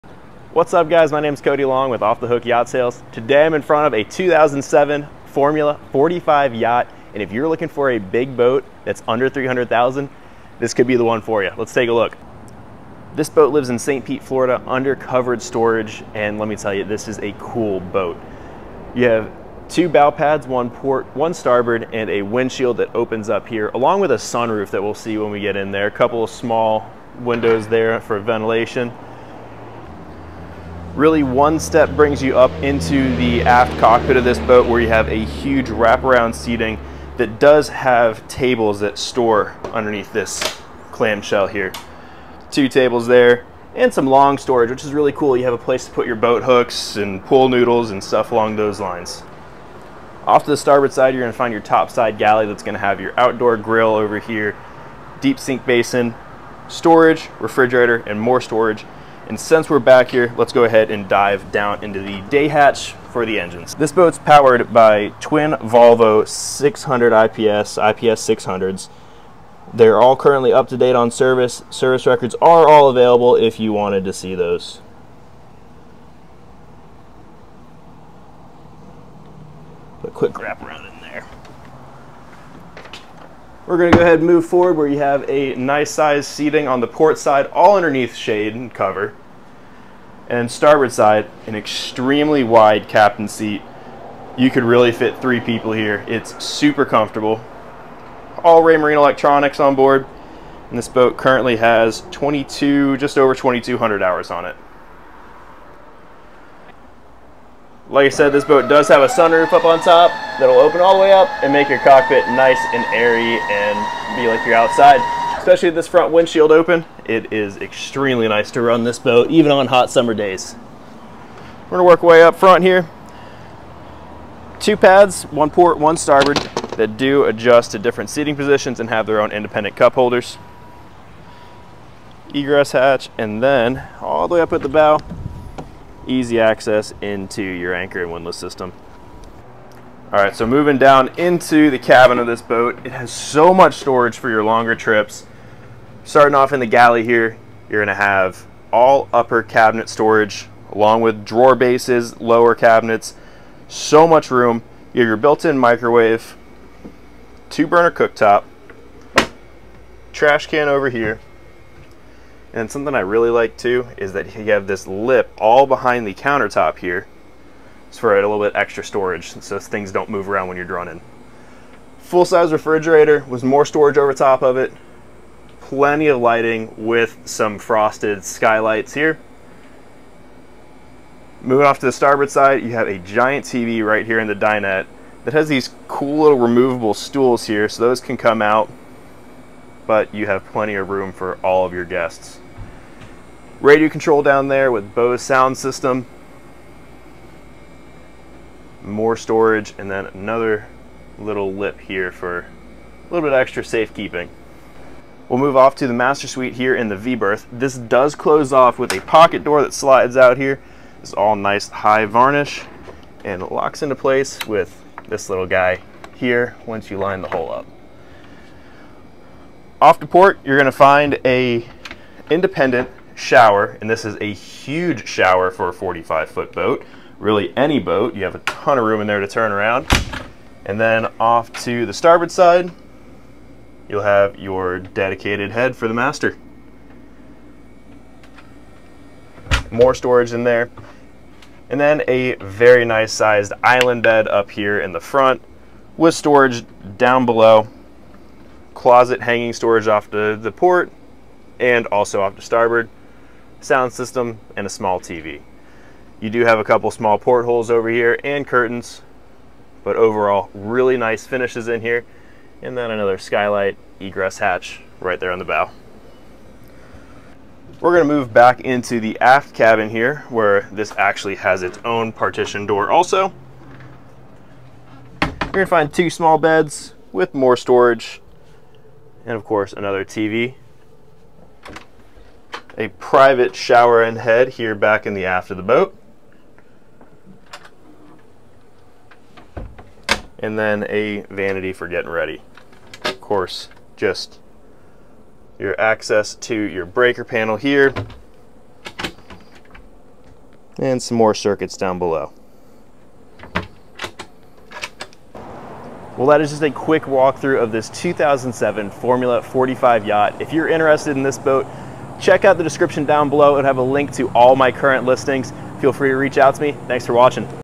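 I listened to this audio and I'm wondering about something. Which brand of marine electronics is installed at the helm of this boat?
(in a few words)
Raymarine.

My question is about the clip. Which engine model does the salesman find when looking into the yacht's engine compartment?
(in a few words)
Volvo IPS 600.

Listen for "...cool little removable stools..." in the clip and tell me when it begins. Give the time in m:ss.
3:05.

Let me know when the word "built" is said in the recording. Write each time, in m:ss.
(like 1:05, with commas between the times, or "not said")
2:35.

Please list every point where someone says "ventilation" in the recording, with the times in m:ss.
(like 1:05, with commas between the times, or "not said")
0:28.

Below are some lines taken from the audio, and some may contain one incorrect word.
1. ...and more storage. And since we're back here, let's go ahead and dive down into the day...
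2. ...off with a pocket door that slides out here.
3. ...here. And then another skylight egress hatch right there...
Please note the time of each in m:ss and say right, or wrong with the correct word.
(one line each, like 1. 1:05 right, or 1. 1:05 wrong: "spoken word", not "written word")
1. 0:58 right
2. 3:28 right
3. 4:21 right.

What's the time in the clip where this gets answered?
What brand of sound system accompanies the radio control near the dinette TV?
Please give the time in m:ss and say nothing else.
3:14.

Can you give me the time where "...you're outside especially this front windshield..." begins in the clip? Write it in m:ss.
1:54.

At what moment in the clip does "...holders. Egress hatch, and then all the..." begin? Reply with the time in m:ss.
2:09.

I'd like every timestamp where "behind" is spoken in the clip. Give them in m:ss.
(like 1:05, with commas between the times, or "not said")
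2:45.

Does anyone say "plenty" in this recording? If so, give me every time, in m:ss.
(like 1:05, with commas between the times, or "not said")
2:55, 3:10.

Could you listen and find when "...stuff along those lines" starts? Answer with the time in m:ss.
0:48.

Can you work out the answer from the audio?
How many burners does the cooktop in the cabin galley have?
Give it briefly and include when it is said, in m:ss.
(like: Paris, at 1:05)
2, at 2:37.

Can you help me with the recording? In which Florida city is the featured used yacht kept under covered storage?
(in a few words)
St. Pete.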